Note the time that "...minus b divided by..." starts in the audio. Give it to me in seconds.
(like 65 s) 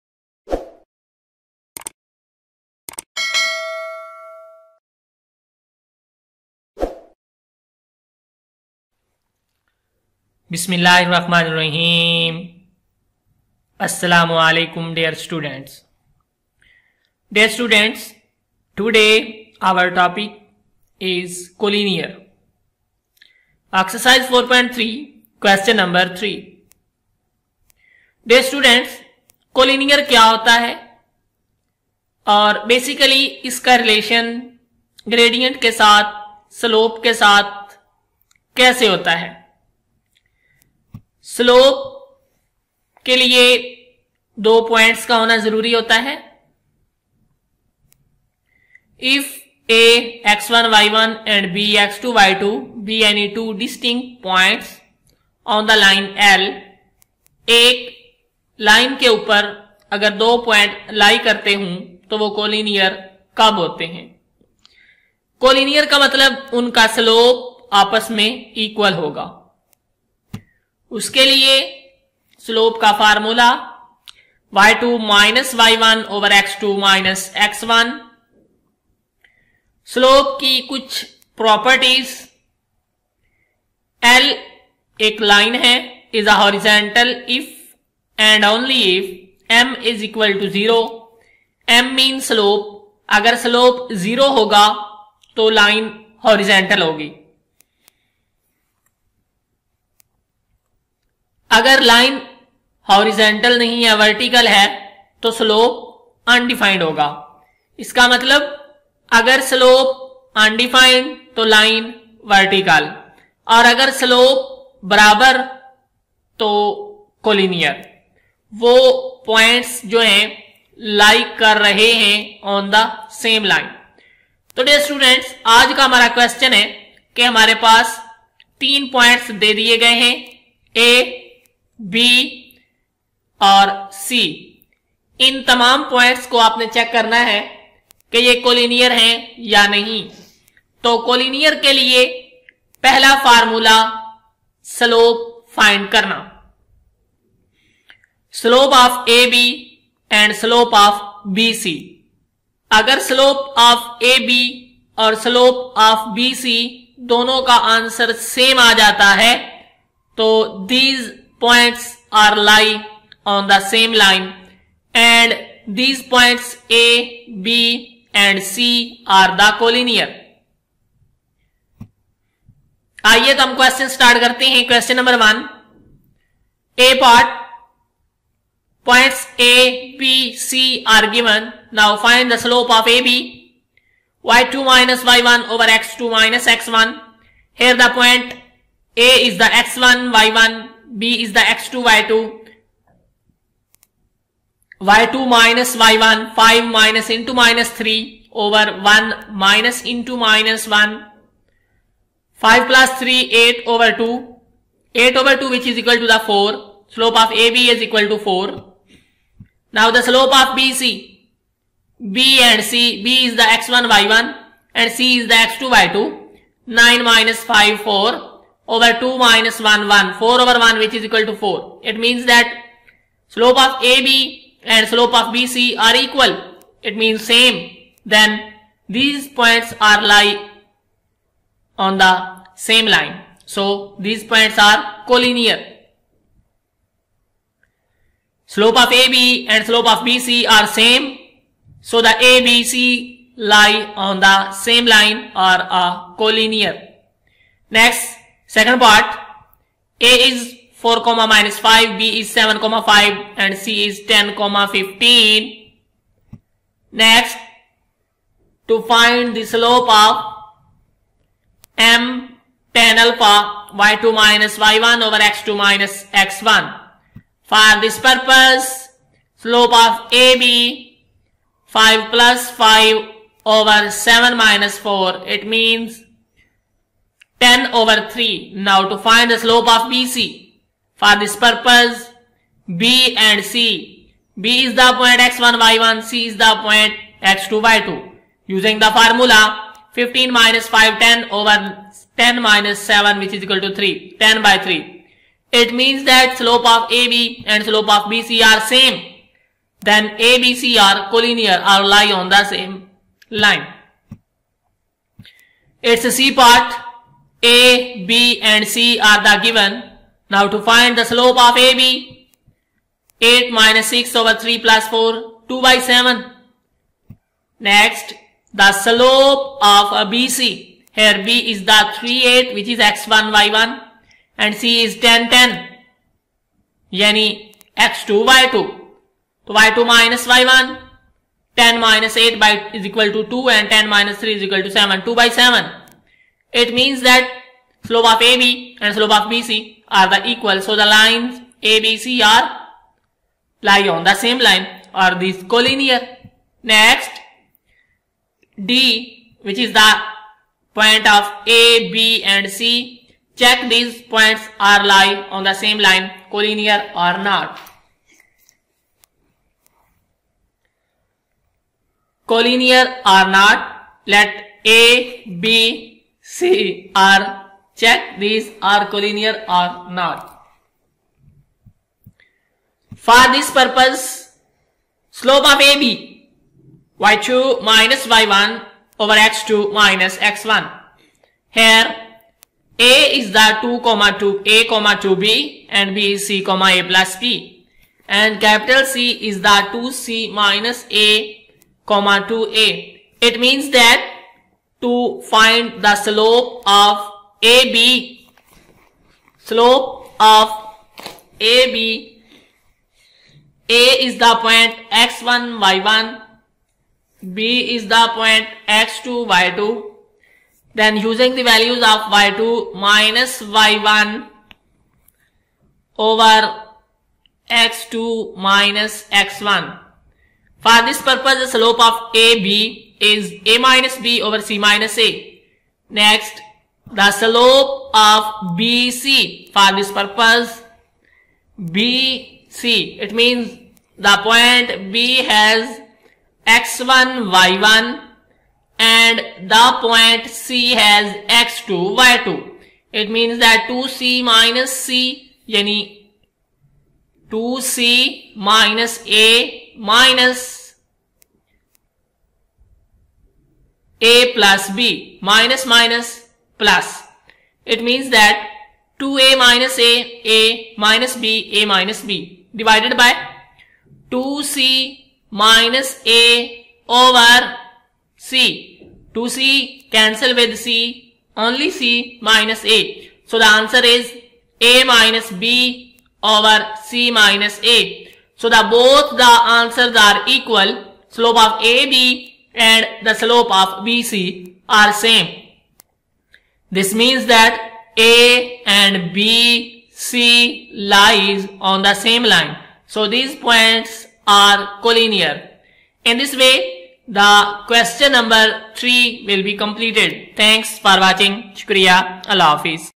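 461 s.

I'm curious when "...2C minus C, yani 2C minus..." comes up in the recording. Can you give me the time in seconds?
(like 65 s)
443 s.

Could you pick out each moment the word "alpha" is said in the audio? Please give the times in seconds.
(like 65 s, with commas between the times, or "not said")
262 s.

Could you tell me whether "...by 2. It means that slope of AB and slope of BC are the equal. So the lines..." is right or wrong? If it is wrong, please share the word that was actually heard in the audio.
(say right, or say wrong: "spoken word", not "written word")
wrong: "7", not "2".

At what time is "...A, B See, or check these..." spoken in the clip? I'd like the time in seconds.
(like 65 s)
364 s.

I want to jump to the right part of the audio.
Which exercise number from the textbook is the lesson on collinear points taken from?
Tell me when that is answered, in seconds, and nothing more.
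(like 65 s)
23 s.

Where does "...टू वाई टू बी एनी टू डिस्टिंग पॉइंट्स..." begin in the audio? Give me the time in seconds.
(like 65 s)
52 s.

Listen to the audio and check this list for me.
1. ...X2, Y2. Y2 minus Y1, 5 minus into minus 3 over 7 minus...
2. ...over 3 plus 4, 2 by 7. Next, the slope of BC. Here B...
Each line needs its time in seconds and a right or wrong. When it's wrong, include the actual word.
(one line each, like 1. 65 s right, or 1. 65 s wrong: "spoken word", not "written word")
1. 191 s wrong: "1", not "7"
2. 314 s right.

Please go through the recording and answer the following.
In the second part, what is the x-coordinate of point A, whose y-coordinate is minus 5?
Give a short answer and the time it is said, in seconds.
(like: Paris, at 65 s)
4, at 250 s.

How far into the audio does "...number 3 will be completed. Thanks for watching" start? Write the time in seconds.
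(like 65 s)
498 s.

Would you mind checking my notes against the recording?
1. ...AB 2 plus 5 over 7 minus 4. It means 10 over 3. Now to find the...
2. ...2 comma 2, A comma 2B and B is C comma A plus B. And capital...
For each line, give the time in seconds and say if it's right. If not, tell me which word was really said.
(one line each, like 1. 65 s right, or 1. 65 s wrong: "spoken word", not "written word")
1. 270 s wrong: "5", not "2"
2. 383 s right.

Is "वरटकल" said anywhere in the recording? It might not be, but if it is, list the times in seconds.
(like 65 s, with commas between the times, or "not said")
103 s, 112 s.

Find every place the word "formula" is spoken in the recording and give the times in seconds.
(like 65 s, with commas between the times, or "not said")
288 s.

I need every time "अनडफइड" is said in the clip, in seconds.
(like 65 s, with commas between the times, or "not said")
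106 s, 110 s.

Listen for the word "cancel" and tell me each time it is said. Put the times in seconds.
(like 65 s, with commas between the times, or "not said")
469 s.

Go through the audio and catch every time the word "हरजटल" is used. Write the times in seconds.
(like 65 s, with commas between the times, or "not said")
86 s, 96 s, 102 s.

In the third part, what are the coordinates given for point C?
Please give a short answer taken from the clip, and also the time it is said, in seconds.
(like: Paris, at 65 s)
(10, 10), at 324 s.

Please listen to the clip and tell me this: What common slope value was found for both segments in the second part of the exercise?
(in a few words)
10/3.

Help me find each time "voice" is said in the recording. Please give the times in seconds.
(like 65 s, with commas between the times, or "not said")
not said.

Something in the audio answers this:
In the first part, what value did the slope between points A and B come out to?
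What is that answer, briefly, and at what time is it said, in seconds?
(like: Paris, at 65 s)
4, at 206 s.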